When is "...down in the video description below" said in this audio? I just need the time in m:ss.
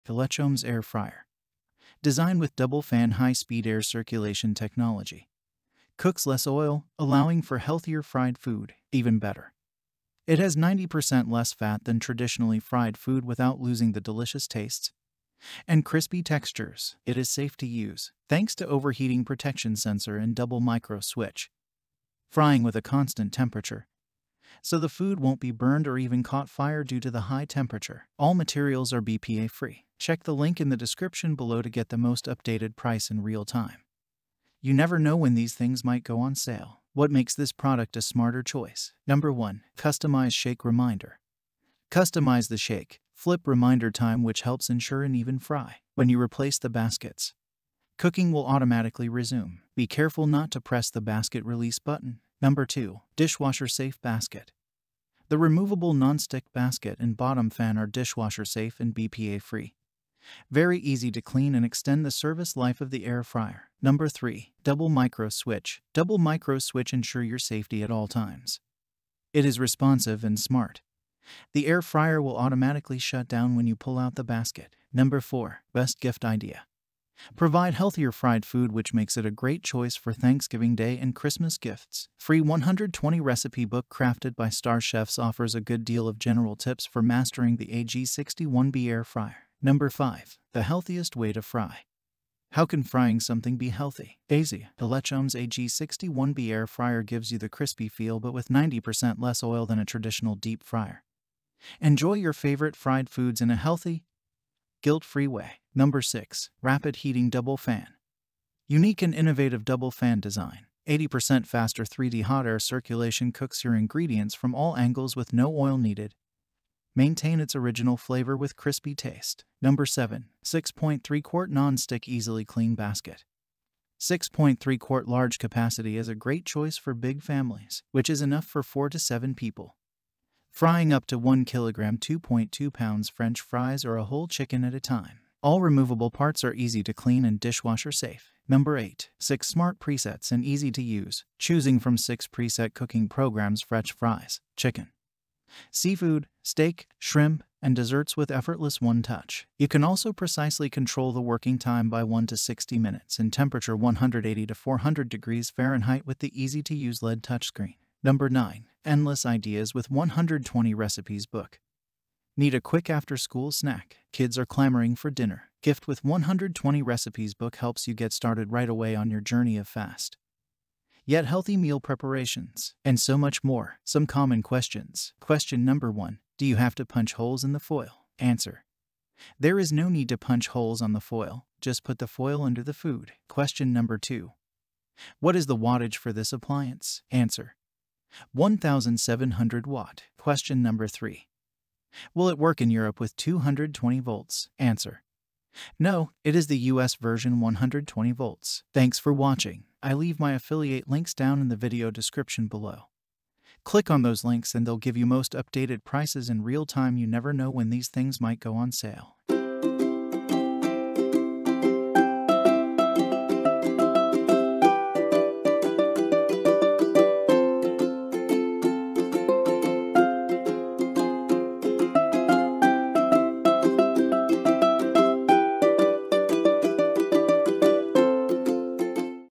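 3:21.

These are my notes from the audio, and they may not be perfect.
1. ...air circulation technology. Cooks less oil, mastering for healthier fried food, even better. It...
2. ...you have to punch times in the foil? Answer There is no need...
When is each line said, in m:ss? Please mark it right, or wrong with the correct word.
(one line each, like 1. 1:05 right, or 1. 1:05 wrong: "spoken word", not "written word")
1. 0:03 wrong: "allowing", not "mastering"
2. 2:56 wrong: "holes", not "times".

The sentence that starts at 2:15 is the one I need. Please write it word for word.
All removable parts are easy to clean and dishwasher safe.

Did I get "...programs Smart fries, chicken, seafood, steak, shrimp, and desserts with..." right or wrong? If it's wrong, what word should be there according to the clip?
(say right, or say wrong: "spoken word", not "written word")
wrong: "French", not "Smart".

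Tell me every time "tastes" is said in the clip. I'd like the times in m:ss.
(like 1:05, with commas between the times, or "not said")
0:14, 1:58.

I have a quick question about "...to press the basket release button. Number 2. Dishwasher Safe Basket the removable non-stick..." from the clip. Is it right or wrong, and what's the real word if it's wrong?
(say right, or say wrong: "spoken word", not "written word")
right.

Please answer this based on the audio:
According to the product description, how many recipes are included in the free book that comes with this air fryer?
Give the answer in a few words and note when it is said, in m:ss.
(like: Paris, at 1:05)
120, at 1:22.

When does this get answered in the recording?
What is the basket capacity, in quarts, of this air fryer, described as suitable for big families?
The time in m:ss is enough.
2:03.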